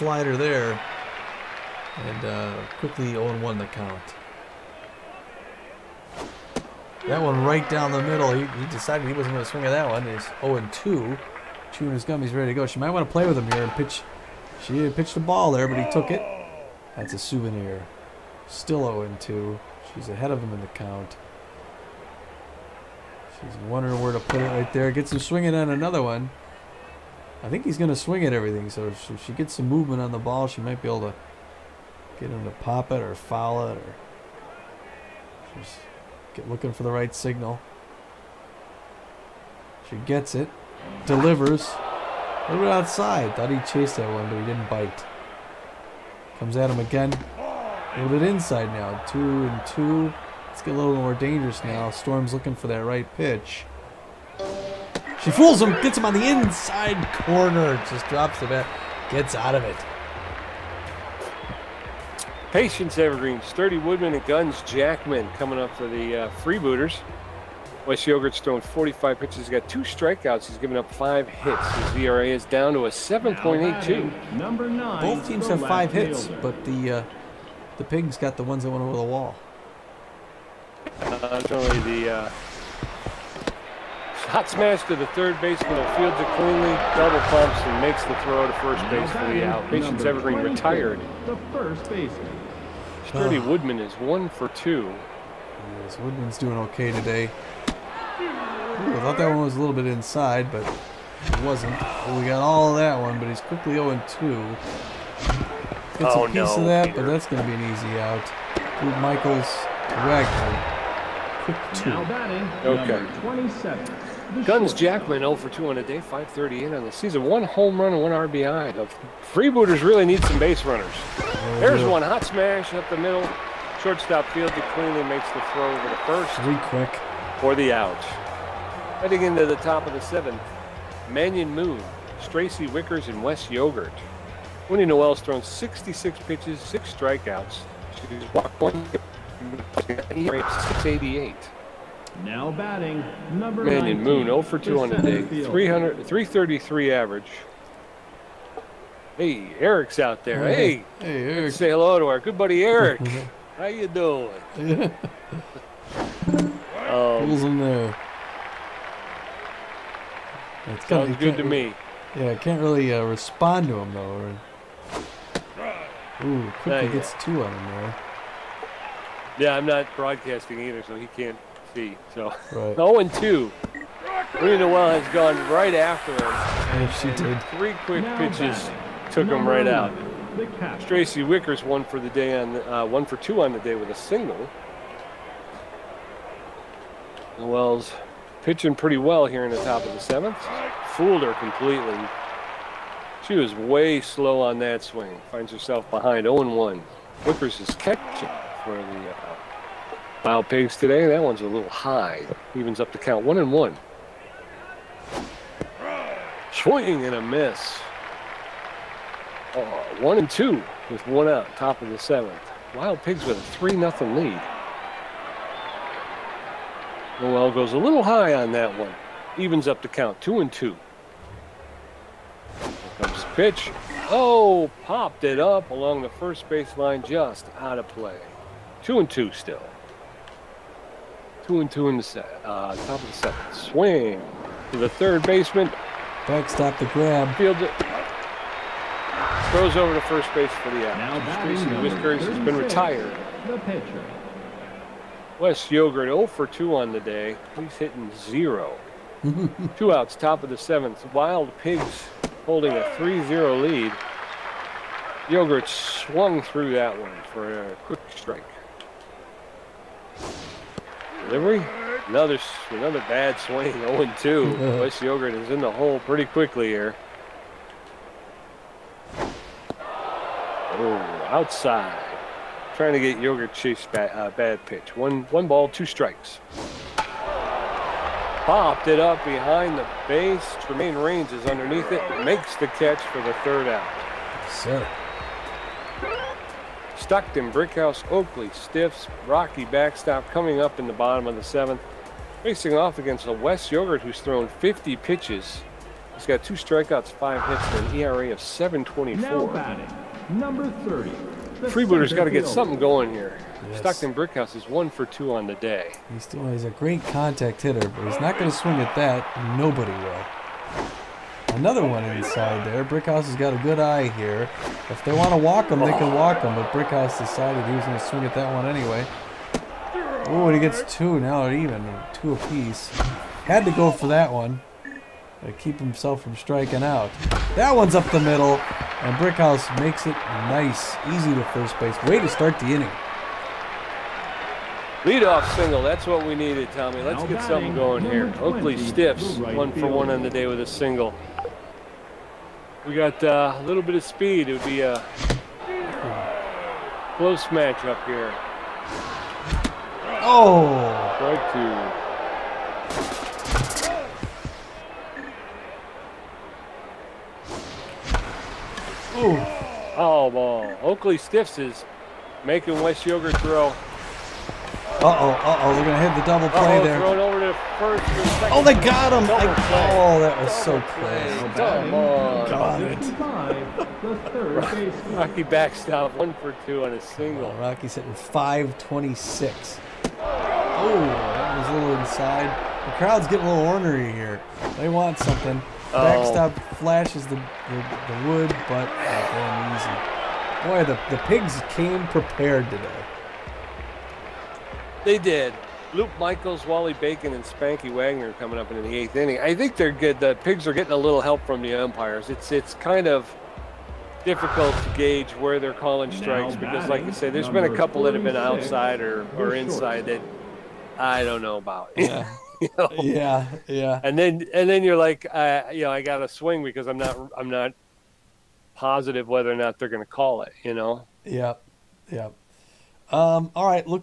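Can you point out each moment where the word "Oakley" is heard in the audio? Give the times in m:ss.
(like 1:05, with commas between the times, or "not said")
4:48, 5:38, 6:00.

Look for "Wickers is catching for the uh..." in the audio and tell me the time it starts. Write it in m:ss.
3:17.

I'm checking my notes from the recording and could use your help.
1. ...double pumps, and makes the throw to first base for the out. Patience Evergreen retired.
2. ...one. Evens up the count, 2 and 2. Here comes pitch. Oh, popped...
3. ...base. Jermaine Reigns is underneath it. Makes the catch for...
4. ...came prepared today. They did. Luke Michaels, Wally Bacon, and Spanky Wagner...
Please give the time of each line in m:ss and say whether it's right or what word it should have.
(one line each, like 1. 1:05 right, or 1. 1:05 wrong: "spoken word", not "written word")
1. 1:26 right
2. 3:38 right
3. 4:40 right
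4. 6:31 right.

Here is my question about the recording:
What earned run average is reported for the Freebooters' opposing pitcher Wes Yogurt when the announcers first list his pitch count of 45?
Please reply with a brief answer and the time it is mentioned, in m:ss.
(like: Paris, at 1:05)
7.82, at 1:12.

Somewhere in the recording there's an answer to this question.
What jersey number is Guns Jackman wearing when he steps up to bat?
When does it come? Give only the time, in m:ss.
1:53.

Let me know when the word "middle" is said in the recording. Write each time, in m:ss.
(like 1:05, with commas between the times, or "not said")
0:08, 2:02, 5:28.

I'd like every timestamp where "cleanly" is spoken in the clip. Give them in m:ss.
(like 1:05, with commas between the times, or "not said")
1:26, 2:04.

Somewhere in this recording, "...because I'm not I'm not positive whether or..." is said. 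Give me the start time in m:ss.
6:56.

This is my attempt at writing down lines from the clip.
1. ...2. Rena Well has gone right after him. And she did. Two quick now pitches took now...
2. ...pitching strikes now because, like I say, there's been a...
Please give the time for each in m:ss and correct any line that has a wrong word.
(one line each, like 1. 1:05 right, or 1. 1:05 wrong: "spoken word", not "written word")
1. 2:53 wrong: "Three", not "Two"
2. 6:45 wrong: "calling", not "pitching".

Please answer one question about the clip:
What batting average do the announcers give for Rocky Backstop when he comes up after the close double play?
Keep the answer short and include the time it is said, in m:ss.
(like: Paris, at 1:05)
.526, at 6:18.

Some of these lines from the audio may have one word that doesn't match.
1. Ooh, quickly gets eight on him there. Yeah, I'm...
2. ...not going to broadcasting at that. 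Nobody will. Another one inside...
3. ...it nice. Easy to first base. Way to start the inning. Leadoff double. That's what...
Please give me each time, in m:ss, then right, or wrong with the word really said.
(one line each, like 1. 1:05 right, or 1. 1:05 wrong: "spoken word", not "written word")
1. 2:46 wrong: "two", not "eight"
2. 5:08 wrong: "swing", not "broadcasting"
3. 5:30 wrong: "single", not "double".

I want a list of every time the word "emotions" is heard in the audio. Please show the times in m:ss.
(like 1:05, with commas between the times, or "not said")
not said.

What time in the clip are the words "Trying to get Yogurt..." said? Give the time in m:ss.
4:32.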